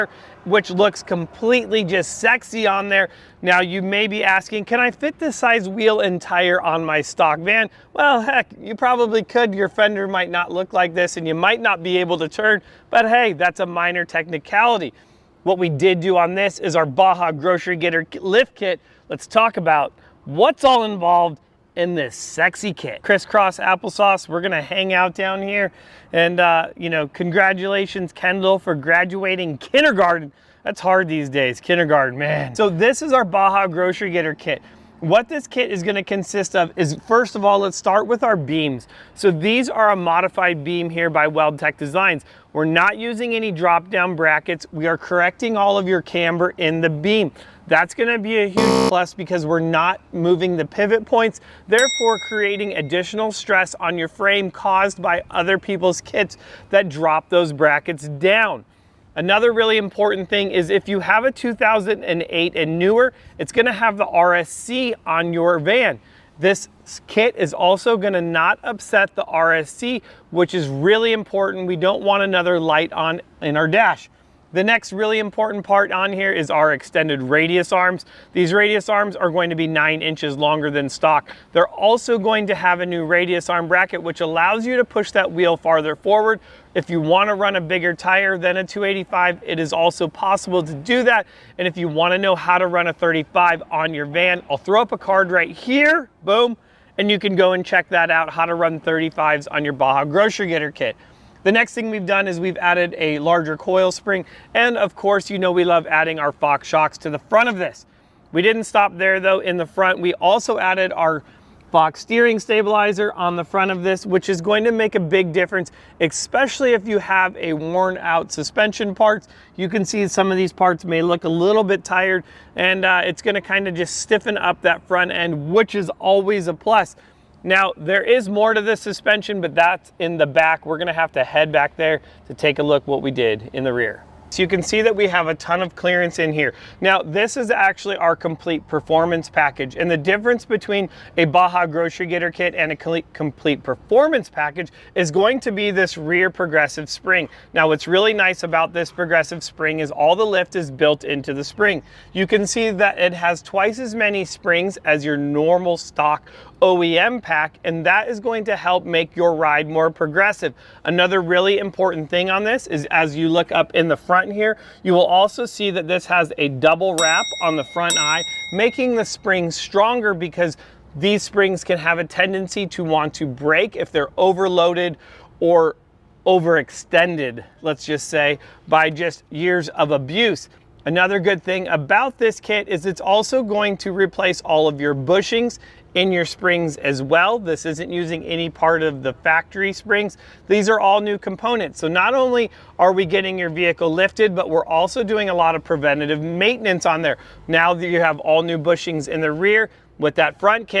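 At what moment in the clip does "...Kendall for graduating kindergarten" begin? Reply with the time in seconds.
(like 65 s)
28 s.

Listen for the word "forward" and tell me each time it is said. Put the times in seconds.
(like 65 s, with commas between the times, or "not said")
85 s.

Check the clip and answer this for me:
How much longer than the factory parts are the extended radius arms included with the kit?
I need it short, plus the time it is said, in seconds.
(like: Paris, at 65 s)
9 inches, at 79 s.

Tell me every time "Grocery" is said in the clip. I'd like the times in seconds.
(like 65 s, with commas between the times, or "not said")
17 s, 33 s, 100 s, 141 s.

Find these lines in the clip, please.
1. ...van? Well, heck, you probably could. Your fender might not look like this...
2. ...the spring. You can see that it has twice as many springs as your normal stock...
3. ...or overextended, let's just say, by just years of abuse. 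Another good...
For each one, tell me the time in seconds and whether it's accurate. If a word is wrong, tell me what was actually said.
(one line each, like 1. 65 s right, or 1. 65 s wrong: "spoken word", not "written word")
1. 7 s right
2. 151 s right
3. 175 s right.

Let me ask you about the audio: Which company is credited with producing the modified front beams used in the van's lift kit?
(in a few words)
WeldTec Designs.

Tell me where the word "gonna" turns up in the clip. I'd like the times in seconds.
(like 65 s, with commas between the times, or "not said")
24 s, 35 s, 47 s, 63 s, 67 s, 123 s, 130 s.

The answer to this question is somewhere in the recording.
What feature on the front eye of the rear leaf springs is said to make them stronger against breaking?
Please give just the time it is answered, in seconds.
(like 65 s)
166 s.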